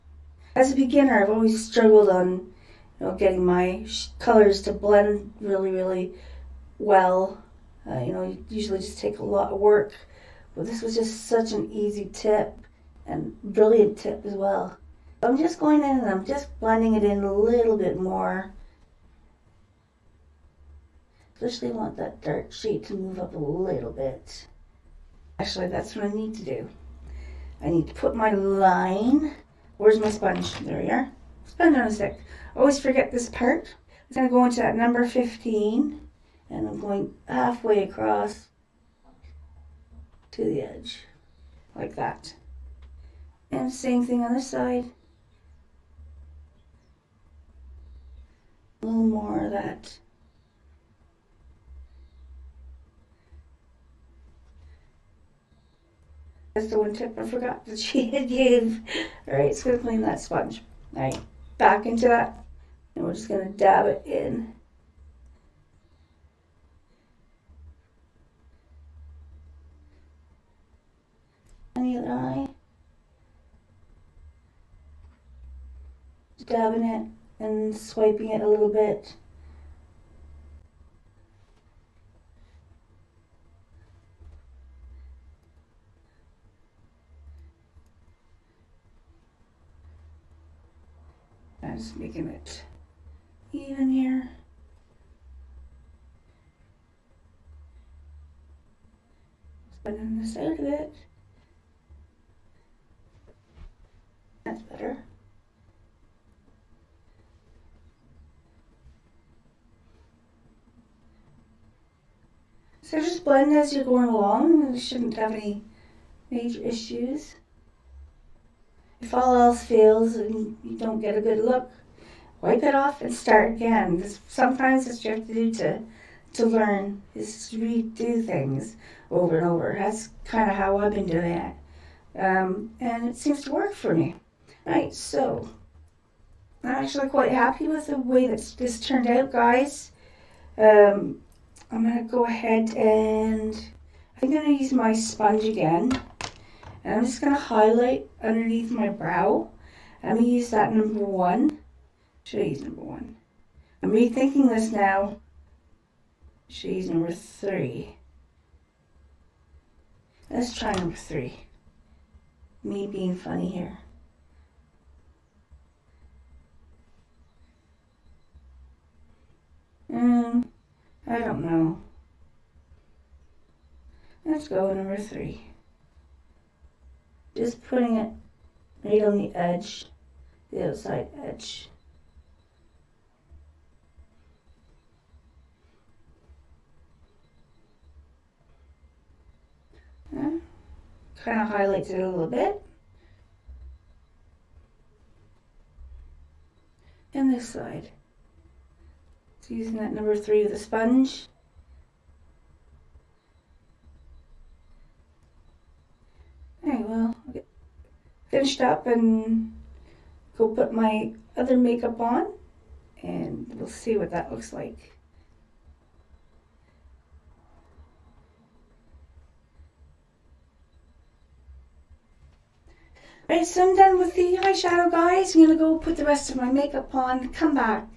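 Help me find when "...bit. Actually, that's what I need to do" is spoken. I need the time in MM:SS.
00:23.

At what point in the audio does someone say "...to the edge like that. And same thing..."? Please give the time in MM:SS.
00:40.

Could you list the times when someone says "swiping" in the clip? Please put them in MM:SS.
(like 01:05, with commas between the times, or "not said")
01:17.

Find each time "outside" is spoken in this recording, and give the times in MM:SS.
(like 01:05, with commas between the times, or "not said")
03:00.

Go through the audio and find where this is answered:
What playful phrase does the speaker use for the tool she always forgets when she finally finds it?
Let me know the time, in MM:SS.
00:31.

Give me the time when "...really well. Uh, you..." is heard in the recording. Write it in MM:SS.
00:05.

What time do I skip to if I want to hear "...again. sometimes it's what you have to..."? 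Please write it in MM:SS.
02:03.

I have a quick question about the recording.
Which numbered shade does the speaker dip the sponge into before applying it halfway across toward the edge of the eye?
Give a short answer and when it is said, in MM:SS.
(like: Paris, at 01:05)
15, at 00:34.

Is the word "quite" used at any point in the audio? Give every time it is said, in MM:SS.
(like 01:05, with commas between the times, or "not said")
02:17.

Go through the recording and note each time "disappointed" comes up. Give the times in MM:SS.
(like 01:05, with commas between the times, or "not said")
not said.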